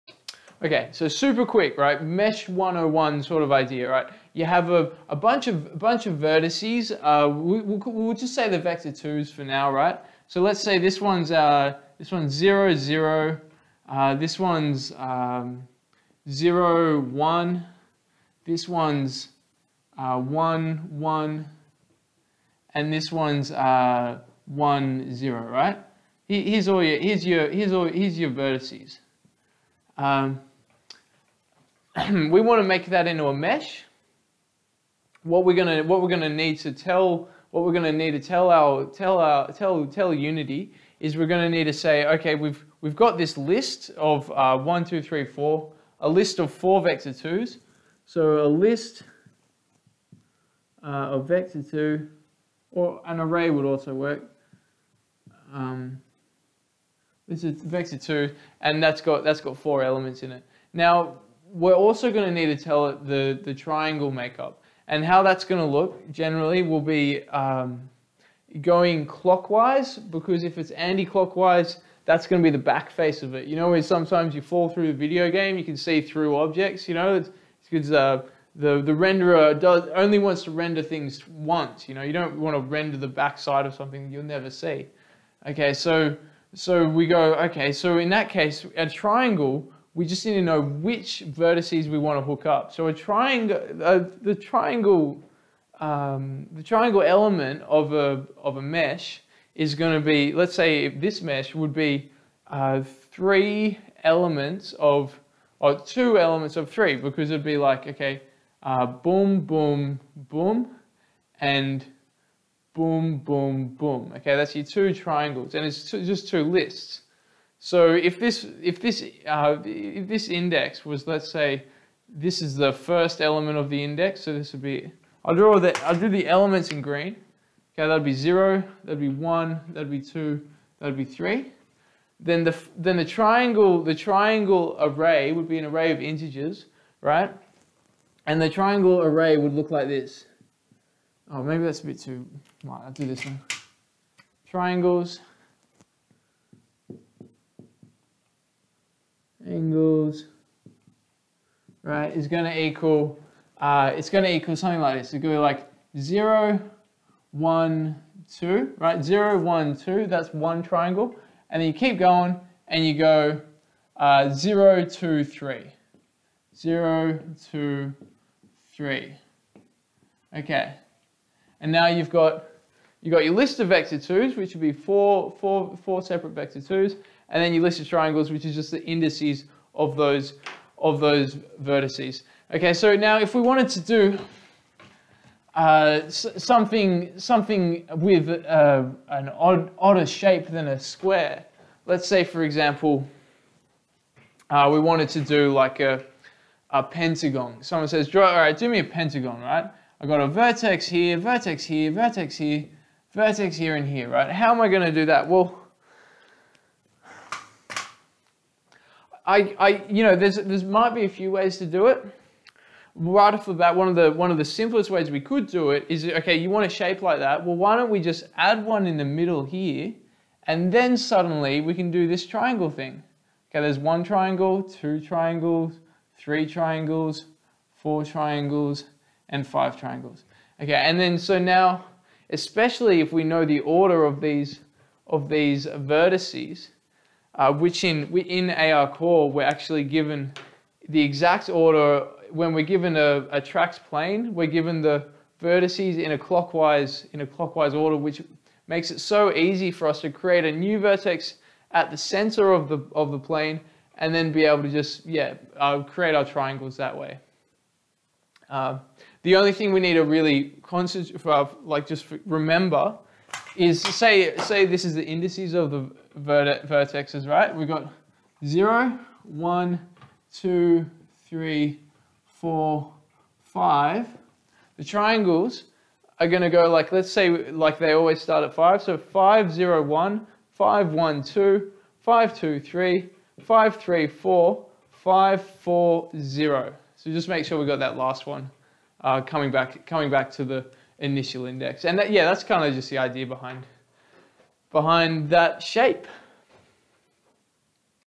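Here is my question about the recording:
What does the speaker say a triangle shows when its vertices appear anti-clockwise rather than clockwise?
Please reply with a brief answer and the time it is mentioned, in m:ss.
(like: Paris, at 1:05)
the back face, at 1:12.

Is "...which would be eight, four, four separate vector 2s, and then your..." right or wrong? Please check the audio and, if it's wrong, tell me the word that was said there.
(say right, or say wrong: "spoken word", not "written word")
wrong: "four", not "eight".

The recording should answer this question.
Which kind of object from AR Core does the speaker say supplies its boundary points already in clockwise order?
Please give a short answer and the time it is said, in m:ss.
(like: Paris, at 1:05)
TrackedPlane, at 4:03.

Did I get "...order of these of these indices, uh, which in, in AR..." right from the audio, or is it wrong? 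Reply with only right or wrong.
wrong.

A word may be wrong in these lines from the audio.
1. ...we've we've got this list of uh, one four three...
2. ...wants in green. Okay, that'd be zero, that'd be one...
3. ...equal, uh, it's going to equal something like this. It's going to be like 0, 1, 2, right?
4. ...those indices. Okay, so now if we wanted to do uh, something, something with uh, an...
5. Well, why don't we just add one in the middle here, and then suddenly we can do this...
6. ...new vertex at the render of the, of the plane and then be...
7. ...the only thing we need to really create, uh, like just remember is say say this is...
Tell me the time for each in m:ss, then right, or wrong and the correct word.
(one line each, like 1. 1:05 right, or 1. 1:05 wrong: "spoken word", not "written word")
1. 0:42 wrong: "two", not "four"
2. 2:06 wrong: "elements", not "wants"
3. 2:32 right
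4. 3:00 wrong: "vertices", not "indices"
5. 3:37 right
6. 4:10 wrong: "center", not "render"
7. 4:19 wrong: "concentrate", not "create".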